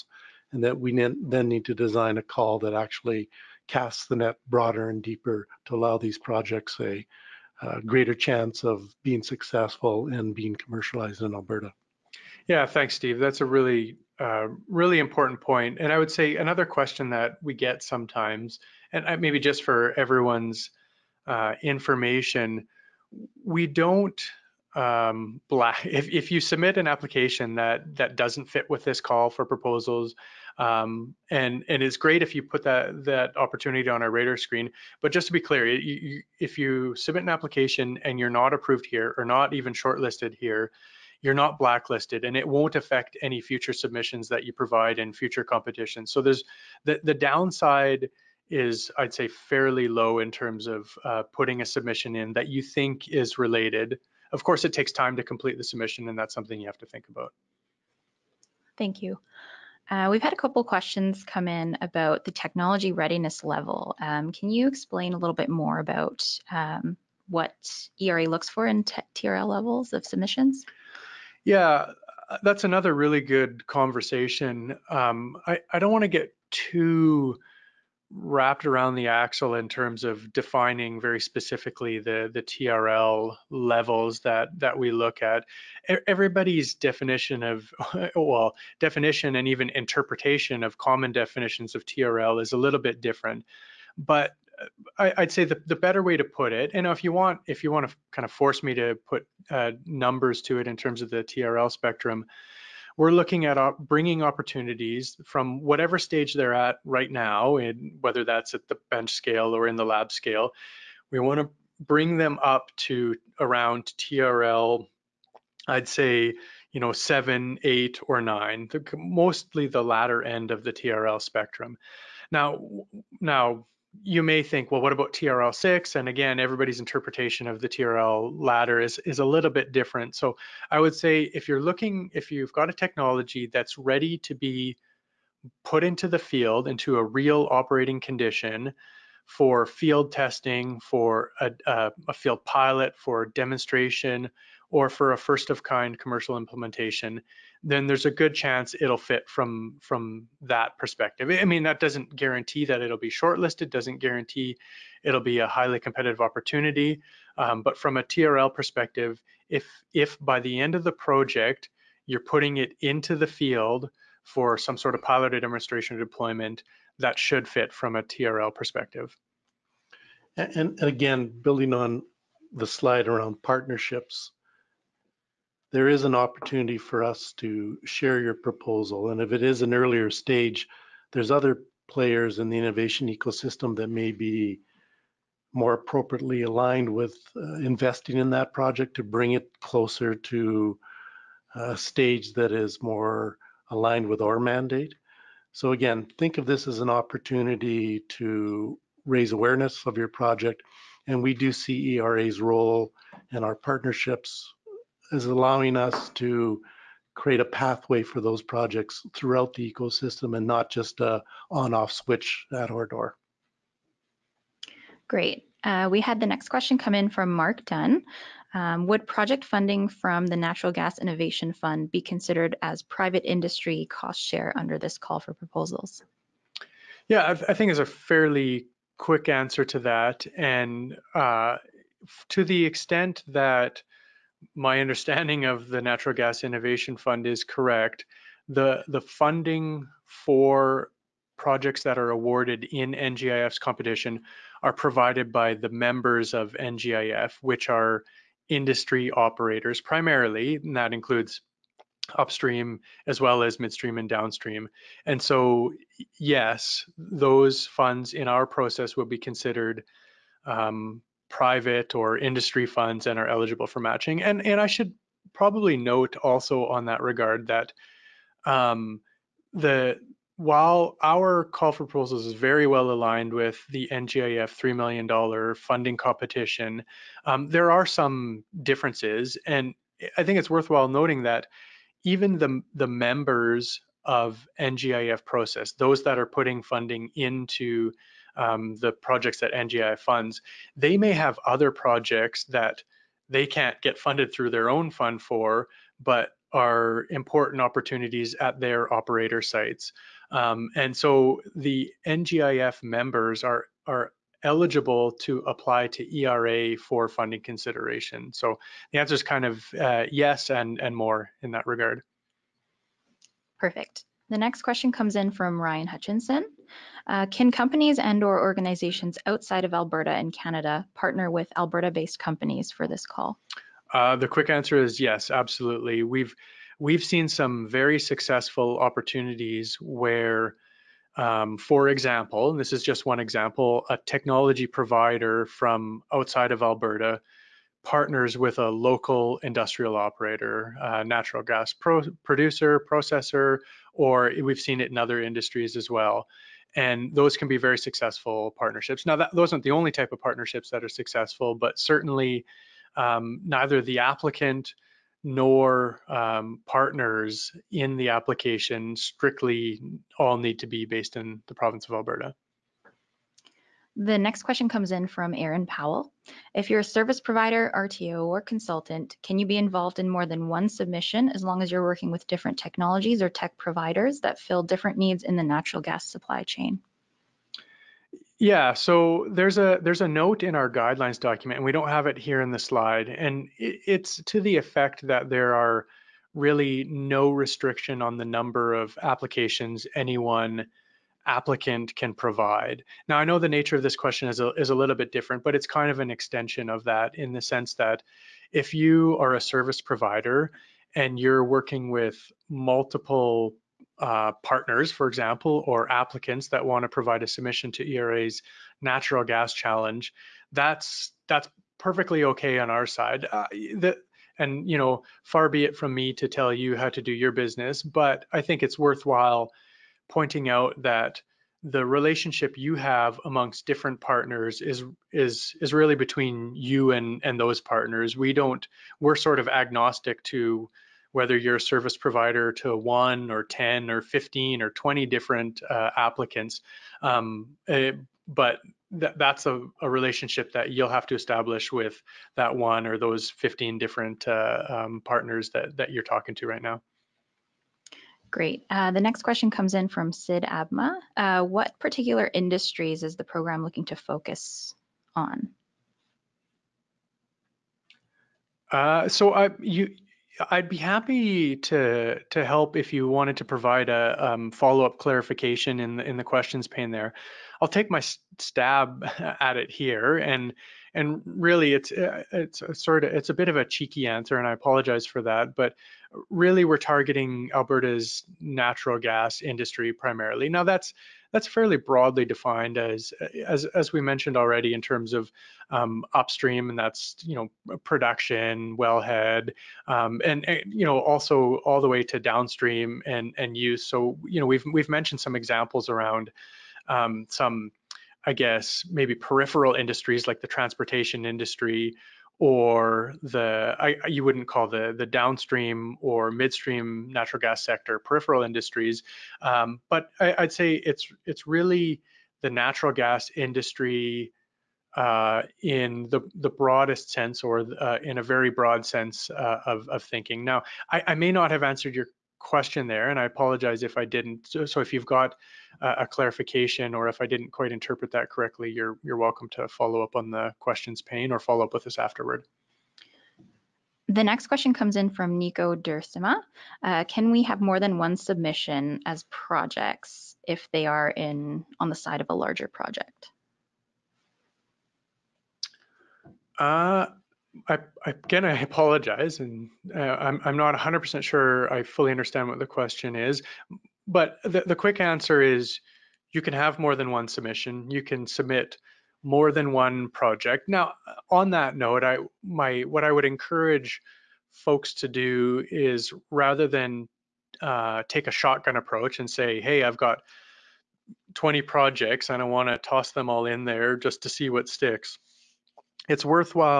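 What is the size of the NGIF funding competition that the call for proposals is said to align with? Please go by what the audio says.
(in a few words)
$3 million.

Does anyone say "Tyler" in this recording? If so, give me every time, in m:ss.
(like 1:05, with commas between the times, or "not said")
not said.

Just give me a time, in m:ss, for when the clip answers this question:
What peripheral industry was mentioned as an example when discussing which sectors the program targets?
8:20.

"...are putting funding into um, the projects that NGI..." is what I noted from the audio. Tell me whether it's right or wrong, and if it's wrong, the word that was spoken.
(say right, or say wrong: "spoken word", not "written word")
right.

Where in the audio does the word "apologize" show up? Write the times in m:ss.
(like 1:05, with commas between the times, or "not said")
7:54, 8:43, 9:08.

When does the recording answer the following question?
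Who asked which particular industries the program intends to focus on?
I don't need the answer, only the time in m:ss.
7:30.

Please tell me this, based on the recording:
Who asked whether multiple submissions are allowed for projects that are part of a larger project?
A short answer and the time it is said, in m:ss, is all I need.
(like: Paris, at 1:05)
Nico Dursima, at 8:55.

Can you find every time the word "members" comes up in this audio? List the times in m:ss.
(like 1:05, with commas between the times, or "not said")
4:05, 4:42, 5:02.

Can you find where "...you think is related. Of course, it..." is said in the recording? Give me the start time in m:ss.
0:52.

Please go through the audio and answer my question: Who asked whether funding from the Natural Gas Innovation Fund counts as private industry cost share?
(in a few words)
Mark Dunn.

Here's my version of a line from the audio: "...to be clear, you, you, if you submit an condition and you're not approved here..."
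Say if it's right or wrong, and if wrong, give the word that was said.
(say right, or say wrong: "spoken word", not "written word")
wrong: "application", not "condition".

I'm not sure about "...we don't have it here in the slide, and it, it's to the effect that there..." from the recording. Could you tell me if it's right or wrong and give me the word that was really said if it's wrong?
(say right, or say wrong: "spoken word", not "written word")
right.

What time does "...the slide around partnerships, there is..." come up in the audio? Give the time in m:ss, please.
2:52.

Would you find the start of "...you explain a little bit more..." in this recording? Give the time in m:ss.
1:04.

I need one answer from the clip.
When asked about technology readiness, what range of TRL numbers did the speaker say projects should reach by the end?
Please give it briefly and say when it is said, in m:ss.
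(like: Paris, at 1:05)
7, 8, or 9, at 1:56.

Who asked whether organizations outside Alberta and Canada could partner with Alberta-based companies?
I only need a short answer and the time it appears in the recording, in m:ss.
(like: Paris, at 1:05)
Ryan Hutchinson, at 5:15.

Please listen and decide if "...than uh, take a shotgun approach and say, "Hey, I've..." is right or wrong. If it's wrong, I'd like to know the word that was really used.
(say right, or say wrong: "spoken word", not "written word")
right.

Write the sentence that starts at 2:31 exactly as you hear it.
I mean, that doesn't guarantee that it'll be shortlisted, doesn't guarantee it'll be a highly competitive opportunity.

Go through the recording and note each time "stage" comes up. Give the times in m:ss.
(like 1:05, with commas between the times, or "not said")
1:45, 3:00, 3:11.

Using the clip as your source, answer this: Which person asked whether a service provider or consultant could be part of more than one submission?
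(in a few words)
Aaron Powell.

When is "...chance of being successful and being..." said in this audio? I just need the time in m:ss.
0:08.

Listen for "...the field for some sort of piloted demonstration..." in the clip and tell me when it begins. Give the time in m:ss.
2:43.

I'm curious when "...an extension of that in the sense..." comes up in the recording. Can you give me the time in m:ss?
6:35.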